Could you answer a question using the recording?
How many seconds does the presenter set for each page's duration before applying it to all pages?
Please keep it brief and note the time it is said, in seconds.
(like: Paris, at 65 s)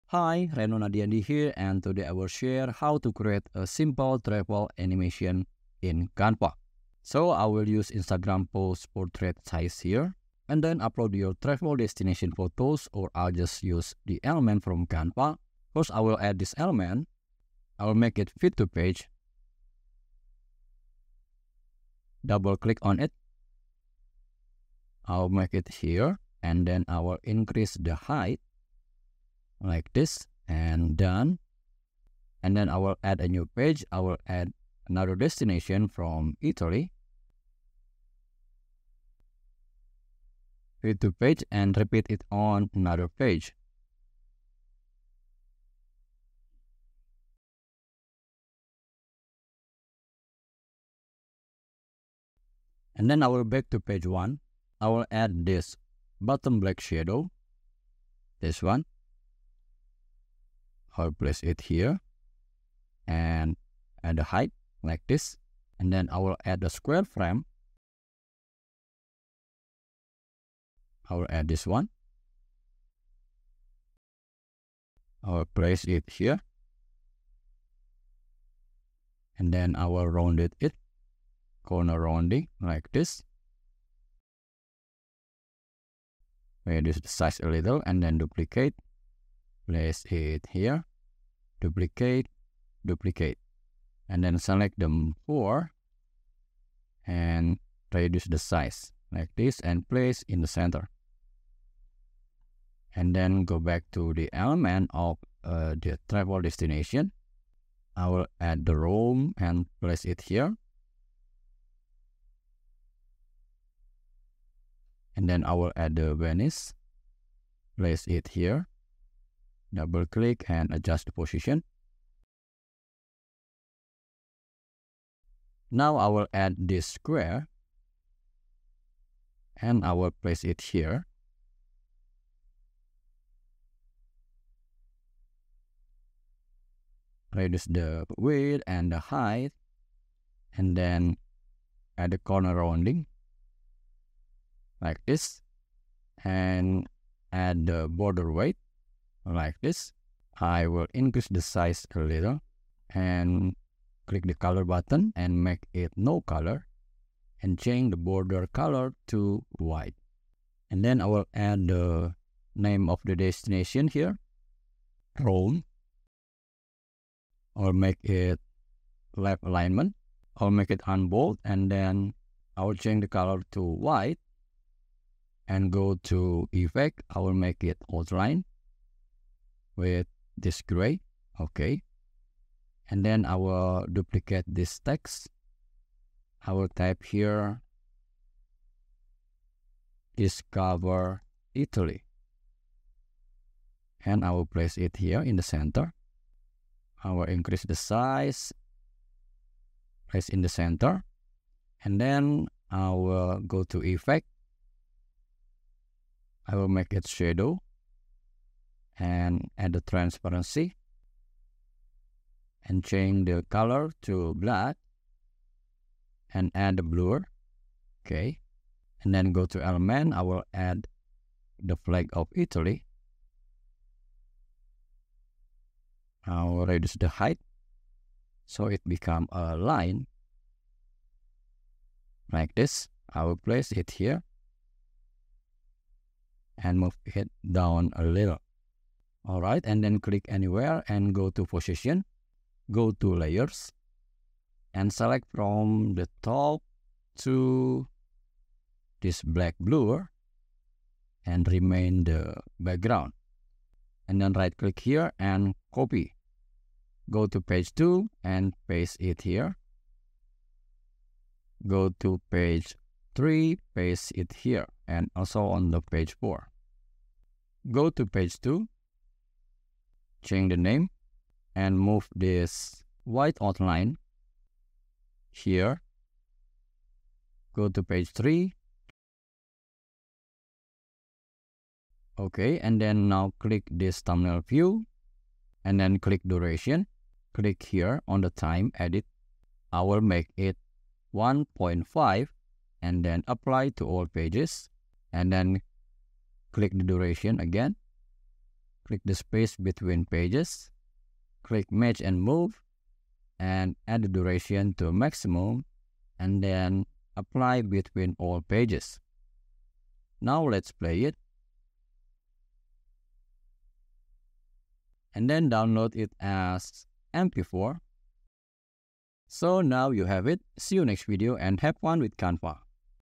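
1.5, at 291 s.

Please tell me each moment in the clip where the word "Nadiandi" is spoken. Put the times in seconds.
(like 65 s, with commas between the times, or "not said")
0 s.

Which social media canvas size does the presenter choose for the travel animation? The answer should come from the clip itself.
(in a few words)
Instagram post portrait.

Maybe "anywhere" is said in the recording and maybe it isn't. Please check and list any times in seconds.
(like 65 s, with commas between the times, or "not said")
240 s.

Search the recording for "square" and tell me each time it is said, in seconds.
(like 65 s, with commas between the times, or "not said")
66 s, 126 s.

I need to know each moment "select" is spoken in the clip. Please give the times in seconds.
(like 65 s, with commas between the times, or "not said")
94 s, 244 s.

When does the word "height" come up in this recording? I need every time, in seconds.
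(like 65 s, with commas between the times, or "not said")
27 s, 64 s, 138 s, 227 s.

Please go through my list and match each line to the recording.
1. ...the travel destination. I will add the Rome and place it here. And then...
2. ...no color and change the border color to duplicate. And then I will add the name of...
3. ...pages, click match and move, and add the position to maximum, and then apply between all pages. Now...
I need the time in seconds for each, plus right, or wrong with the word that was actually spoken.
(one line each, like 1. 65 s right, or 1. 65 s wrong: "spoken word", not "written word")
1. 105 s right
2. 155 s wrong: "white", not "duplicate"
3. 300 s wrong: "duration", not "position".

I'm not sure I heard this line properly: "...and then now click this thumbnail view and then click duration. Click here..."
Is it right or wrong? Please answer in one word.
right.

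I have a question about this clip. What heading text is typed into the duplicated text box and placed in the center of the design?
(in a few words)
Discover Italy.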